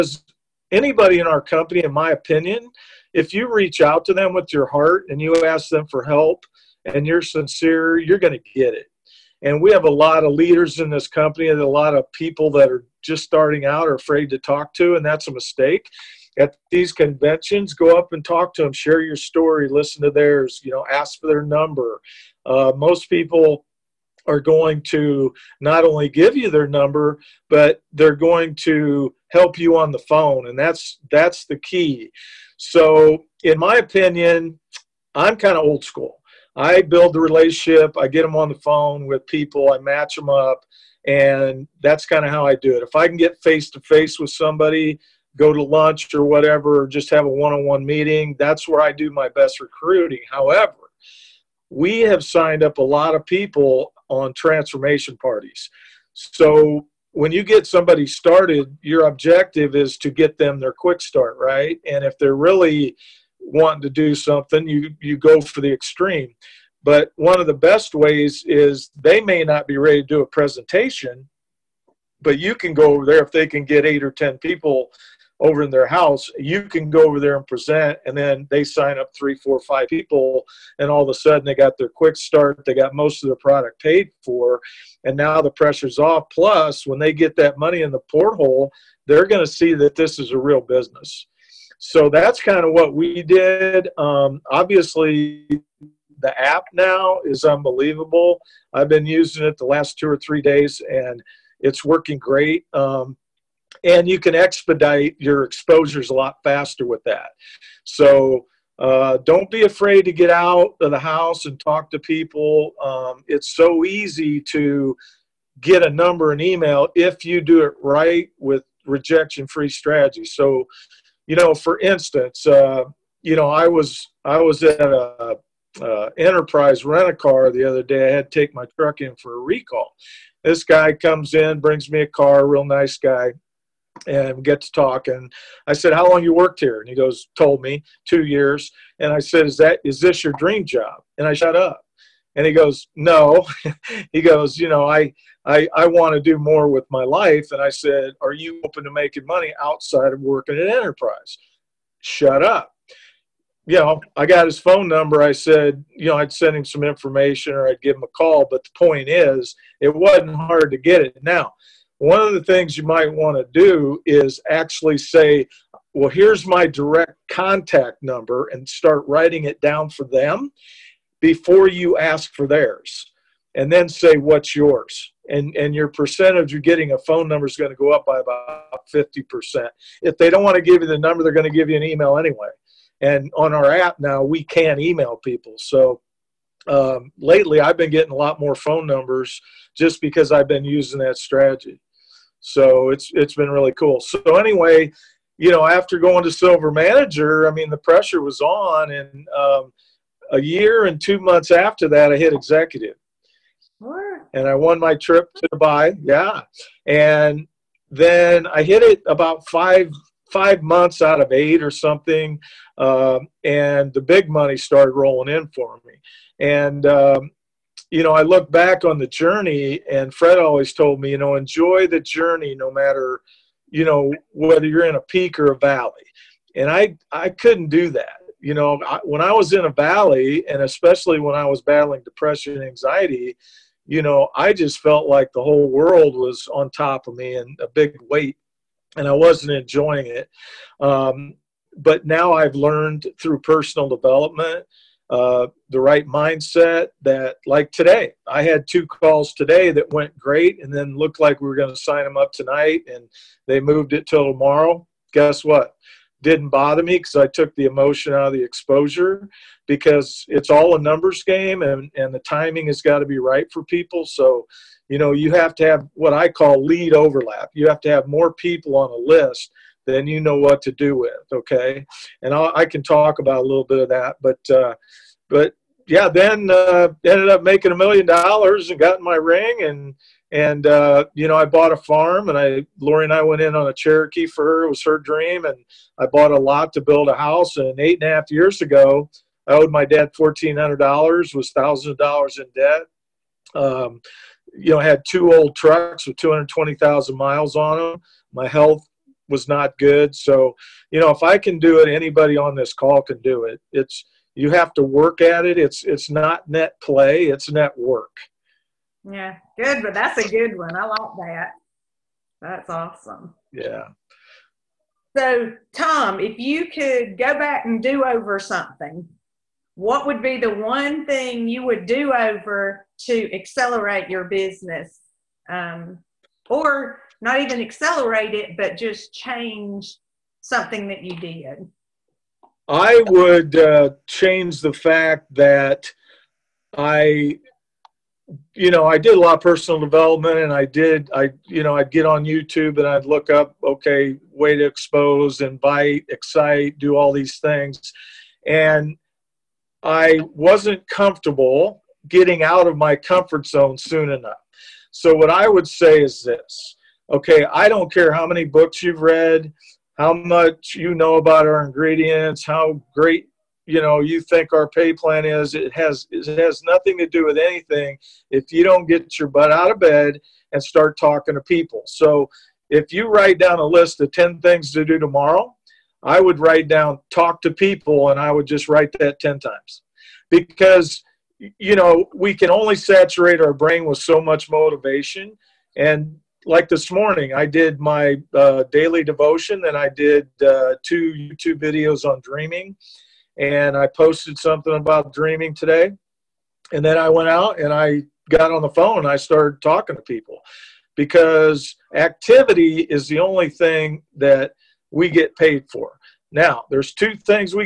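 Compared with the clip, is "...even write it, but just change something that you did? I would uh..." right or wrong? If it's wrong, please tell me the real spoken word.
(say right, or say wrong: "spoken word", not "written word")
wrong: "accelerate", not "write".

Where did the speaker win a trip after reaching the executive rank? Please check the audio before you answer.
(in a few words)
Dubai.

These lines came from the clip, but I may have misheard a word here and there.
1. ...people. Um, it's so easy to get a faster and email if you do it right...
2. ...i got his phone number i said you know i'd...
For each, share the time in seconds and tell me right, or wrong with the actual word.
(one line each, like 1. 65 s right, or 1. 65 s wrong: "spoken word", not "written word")
1. 111 s wrong: "number", not "faster"
2. 154 s right.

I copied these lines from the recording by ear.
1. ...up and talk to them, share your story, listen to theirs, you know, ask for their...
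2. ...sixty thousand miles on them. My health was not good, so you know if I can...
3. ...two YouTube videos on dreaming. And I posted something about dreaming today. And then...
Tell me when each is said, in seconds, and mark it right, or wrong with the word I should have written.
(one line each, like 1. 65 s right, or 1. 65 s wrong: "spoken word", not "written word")
1. 17 s right
2. 296 s wrong: "twenty", not "sixty"
3. 390 s right.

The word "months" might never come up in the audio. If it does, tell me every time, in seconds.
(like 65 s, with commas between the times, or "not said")
201 s, 210 s.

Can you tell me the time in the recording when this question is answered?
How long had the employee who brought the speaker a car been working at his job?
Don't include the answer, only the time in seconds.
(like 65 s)
138 s.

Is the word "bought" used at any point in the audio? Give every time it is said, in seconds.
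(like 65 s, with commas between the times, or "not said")
281 s, 286 s.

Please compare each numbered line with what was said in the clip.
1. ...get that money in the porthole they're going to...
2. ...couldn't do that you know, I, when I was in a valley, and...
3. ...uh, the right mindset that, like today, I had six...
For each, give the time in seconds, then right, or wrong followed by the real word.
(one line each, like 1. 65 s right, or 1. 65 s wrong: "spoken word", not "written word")
1. 87 s right
2. 227 s right
3. 245 s wrong: "two", not "six".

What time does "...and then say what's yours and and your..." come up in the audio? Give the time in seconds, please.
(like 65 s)
173 s.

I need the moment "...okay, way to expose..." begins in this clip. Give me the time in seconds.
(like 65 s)
343 s.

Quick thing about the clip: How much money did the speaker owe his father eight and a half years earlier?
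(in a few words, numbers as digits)
$1,400.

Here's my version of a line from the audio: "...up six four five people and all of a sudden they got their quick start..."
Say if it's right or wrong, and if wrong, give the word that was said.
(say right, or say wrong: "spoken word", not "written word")
wrong: "three", not "six".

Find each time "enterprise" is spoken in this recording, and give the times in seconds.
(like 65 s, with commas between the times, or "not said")
126 s, 150 s.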